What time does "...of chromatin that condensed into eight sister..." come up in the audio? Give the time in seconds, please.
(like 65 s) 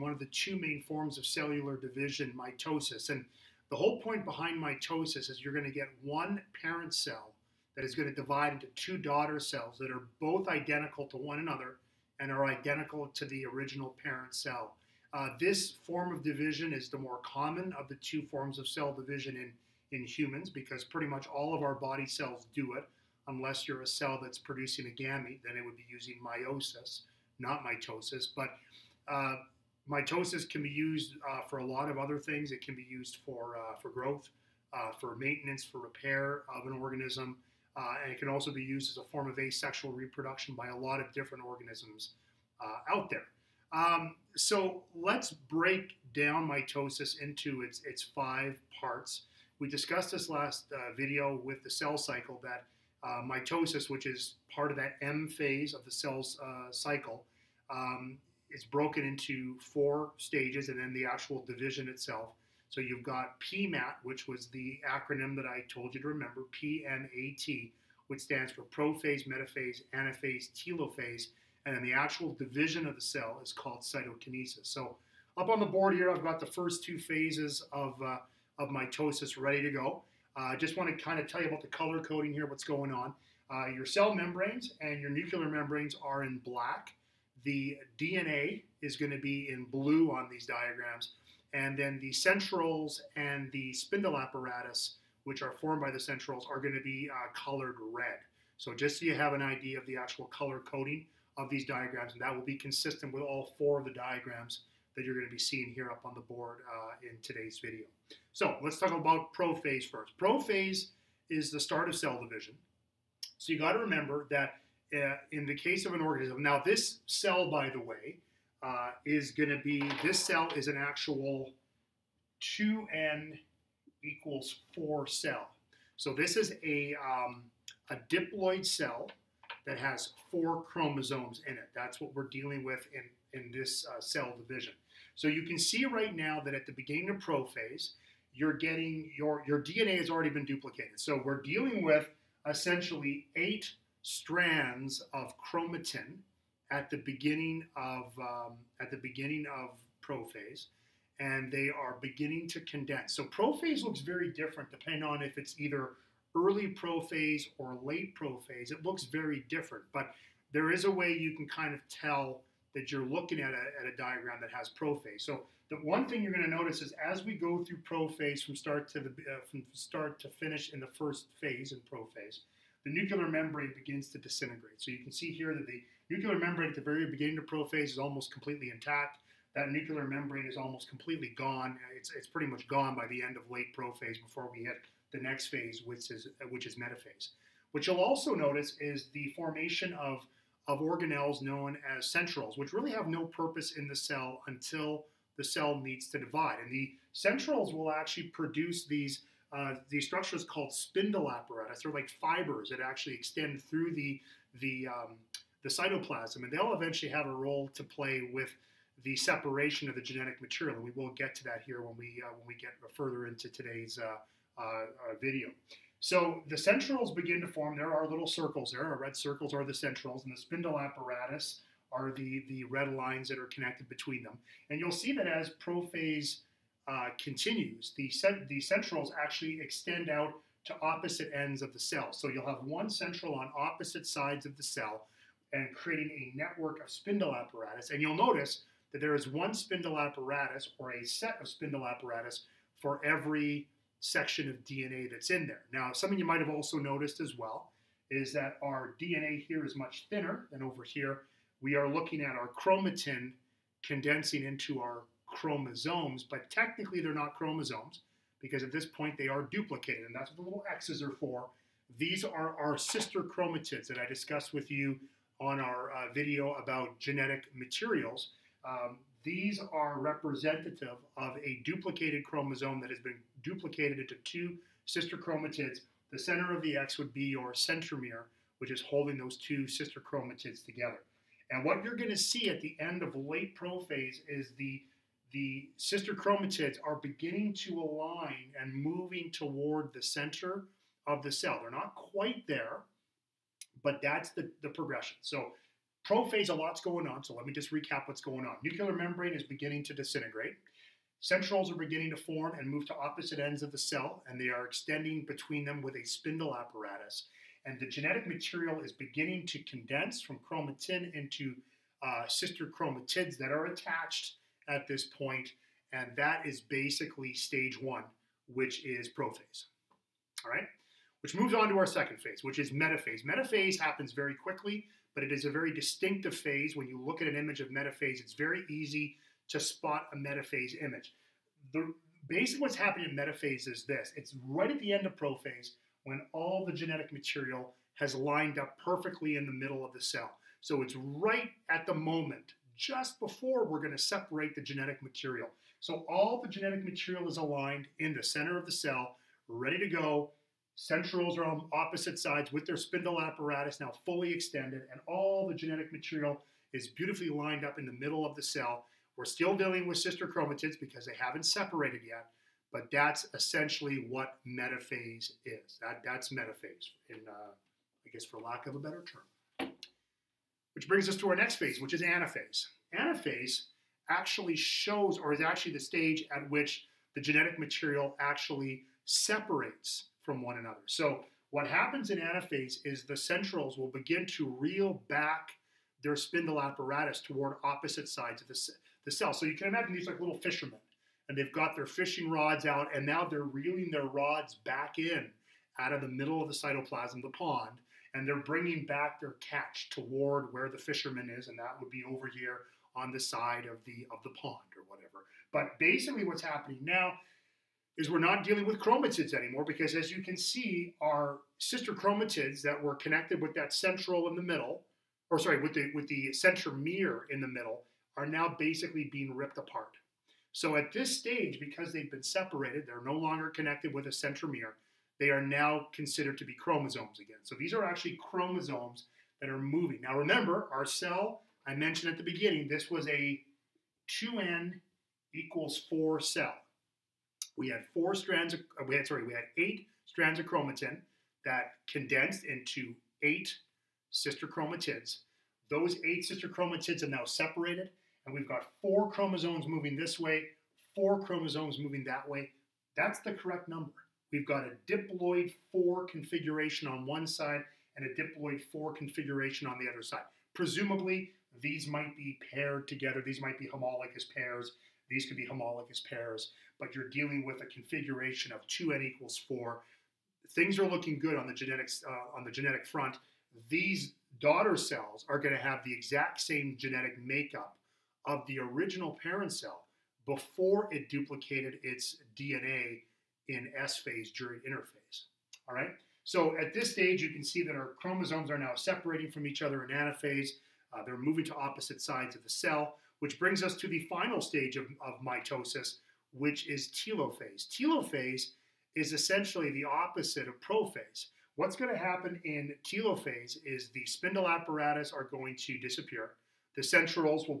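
440 s.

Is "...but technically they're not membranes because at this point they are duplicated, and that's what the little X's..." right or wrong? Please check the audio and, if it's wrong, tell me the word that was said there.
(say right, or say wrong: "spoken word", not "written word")
wrong: "chromosomes", not "membranes".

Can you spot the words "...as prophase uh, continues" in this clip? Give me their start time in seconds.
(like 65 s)
225 s.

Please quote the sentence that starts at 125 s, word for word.
So this is a, um, a diploid cell that has four chromosomes in it.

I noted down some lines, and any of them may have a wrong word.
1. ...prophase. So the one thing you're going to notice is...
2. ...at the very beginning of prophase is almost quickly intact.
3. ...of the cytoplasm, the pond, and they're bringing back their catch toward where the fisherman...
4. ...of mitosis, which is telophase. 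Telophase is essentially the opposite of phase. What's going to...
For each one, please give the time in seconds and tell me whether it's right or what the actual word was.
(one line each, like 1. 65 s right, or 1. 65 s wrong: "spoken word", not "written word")
1. 164 s right
2. 176 s wrong: "completely", not "quickly"
3. 396 s right
4. 495 s wrong: "prophase", not "phase".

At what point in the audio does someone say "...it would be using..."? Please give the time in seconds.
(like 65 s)
25 s.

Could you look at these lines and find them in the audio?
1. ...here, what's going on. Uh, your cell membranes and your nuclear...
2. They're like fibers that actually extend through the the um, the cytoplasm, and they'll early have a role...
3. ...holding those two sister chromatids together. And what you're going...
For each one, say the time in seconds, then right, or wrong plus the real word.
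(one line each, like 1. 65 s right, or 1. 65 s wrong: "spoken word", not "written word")
1. 82 s right
2. 201 s wrong: "eventually", not "early"
3. 278 s right.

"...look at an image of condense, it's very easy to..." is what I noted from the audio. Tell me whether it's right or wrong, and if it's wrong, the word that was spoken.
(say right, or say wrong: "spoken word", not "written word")
wrong: "metaphase", not "condense".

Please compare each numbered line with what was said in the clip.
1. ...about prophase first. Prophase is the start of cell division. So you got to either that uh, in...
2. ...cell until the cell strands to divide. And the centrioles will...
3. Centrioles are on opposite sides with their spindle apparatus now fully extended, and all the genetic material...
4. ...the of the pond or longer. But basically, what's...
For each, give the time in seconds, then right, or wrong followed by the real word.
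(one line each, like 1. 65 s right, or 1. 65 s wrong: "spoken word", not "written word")
1. 108 s wrong: "remember", not "either"
2. 193 s wrong: "needs", not "strands"
3. 350 s right
4. 403 s wrong: "whatever", not "longer".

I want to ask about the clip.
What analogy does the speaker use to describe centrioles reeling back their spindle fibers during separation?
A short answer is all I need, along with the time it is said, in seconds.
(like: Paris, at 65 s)
Fishermen, at 390 s.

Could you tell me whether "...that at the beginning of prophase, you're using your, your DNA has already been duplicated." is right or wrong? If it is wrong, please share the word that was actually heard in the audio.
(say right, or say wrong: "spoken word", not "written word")
wrong: "getting", not "using".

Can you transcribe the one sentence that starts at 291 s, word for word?
They're not quite there, but that's the, the progression.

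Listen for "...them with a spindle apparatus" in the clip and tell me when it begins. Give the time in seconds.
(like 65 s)
305 s.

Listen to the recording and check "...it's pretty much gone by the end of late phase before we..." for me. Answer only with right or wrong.
wrong.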